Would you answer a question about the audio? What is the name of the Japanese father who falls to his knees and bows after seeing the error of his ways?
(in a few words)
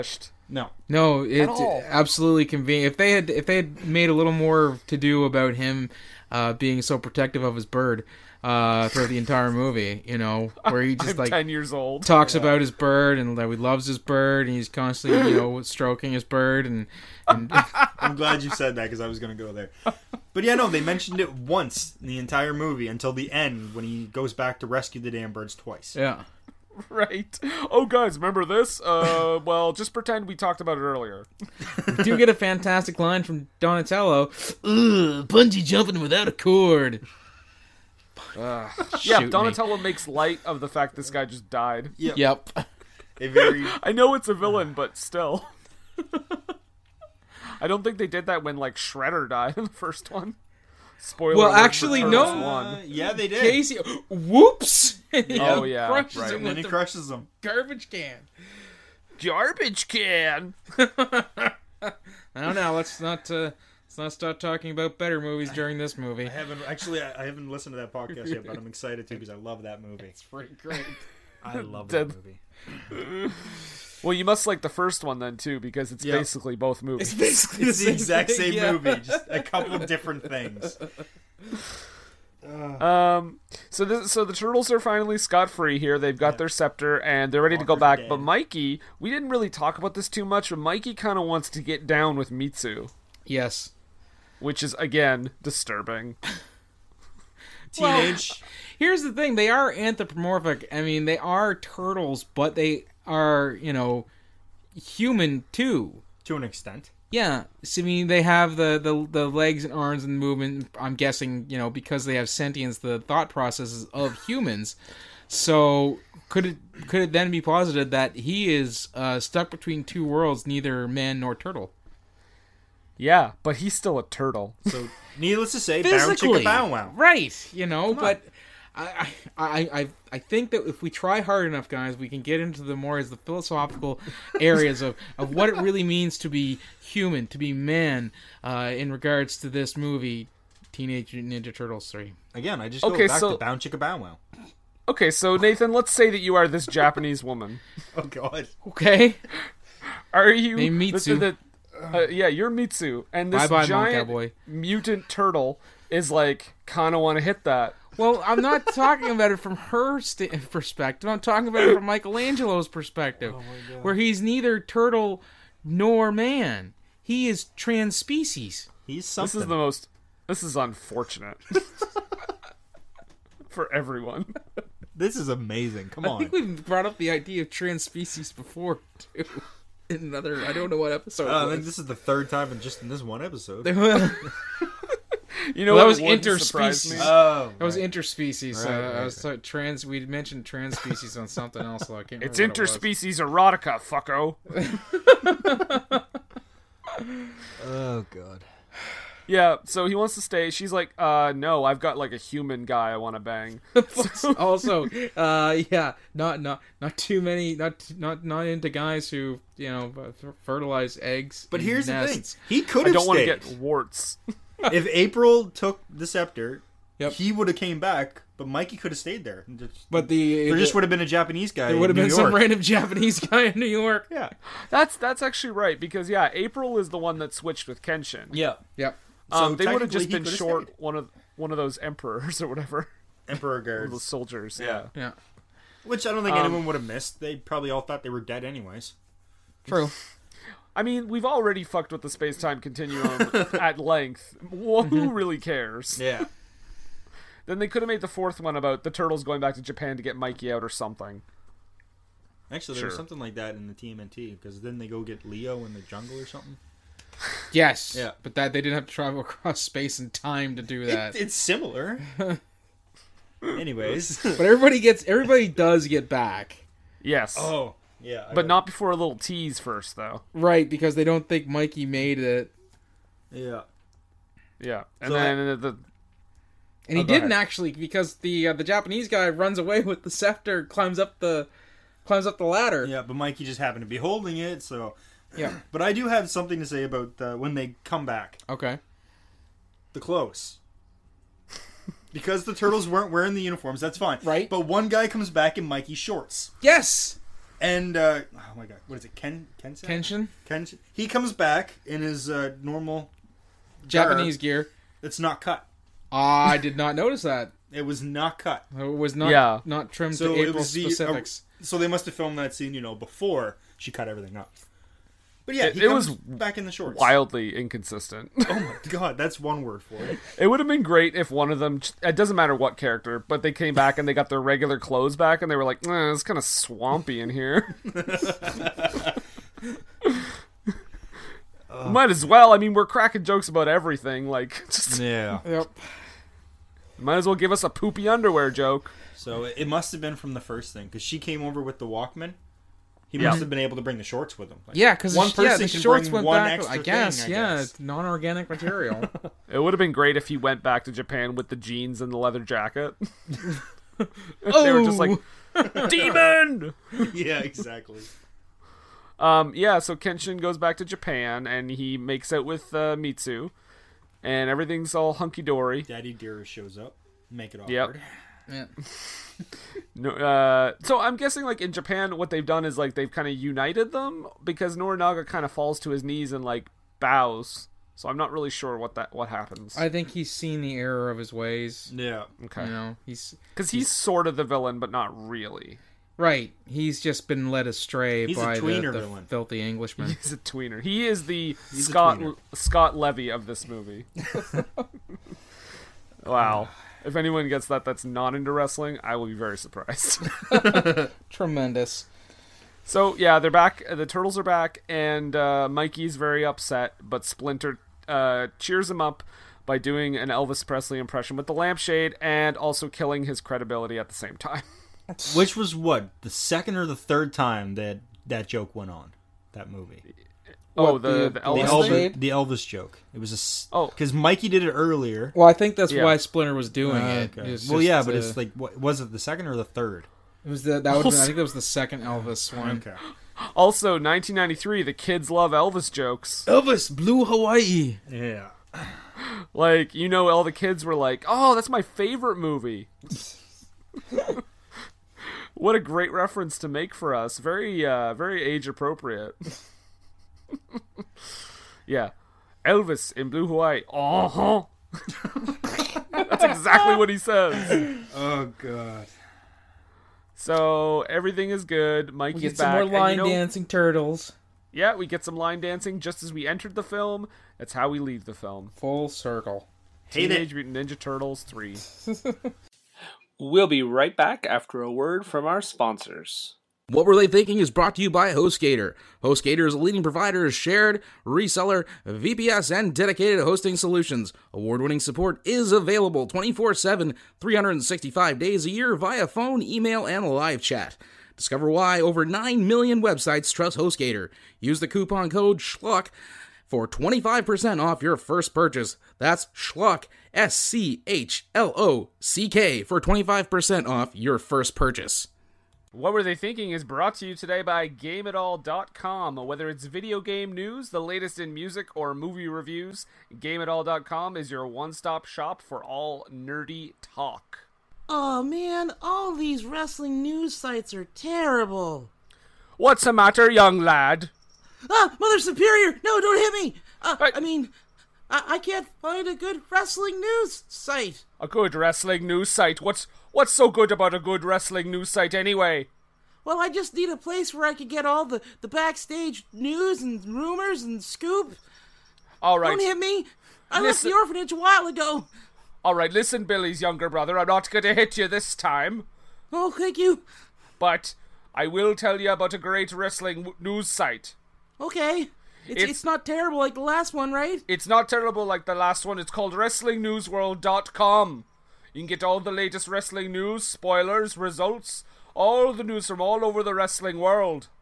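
Norinaga.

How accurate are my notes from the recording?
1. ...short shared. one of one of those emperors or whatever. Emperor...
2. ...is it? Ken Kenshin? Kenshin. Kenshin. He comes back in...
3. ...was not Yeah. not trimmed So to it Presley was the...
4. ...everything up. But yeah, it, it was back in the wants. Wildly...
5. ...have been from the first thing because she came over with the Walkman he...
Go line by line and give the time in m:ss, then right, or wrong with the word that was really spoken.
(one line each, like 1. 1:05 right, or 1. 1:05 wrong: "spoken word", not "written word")
1. 3:50 wrong: "stayed", not "shared"
2. 4:58 right
3. 5:08 wrong: "April", not "Presley"
4. 5:14 wrong: "shorts", not "wants"
5. 5:39 right.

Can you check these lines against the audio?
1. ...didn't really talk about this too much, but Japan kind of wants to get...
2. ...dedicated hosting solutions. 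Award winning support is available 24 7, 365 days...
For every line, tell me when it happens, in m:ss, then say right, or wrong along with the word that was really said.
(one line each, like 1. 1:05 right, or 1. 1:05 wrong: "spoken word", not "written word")
1. 1:29 wrong: "Mikey", not "Japan"
2. 8:02 right.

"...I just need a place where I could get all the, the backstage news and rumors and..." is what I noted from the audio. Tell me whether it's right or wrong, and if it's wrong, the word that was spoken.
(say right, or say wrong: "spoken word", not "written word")
right.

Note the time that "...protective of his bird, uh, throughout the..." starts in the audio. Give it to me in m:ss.
0:06.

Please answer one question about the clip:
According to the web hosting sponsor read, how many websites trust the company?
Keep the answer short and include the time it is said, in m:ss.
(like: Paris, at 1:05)
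over 9 million, at 8:12.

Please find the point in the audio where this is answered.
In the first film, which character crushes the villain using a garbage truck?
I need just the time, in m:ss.
0:53.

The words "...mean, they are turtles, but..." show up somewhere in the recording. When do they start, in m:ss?
1:40.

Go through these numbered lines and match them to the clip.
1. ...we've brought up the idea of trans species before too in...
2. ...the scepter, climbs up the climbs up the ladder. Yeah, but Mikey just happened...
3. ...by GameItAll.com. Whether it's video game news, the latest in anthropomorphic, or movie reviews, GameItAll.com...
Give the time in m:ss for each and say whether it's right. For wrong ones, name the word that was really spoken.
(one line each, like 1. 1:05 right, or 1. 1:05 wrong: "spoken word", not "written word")
1. 2:56 right
2. 4:40 right
3. 8:27 wrong: "music", not "anthropomorphic".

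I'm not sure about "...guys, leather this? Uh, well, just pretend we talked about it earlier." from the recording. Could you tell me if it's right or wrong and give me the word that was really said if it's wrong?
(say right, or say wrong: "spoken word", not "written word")
wrong: "remember", not "leather".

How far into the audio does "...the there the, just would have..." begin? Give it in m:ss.
3:40.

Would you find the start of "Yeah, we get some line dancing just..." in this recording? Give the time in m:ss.
7:44.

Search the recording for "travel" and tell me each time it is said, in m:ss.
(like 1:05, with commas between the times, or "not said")
4:18.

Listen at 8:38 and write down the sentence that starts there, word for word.
Oh man, all these wrestling news sites are terrible.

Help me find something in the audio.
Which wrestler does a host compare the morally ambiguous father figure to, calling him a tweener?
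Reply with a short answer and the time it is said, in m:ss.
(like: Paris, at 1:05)
Scott Levy, at 6:32.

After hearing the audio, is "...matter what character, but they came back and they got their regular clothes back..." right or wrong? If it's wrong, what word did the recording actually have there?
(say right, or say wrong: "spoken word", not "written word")
right.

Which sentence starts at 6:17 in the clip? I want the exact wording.
So I'm not really sure what that what happens.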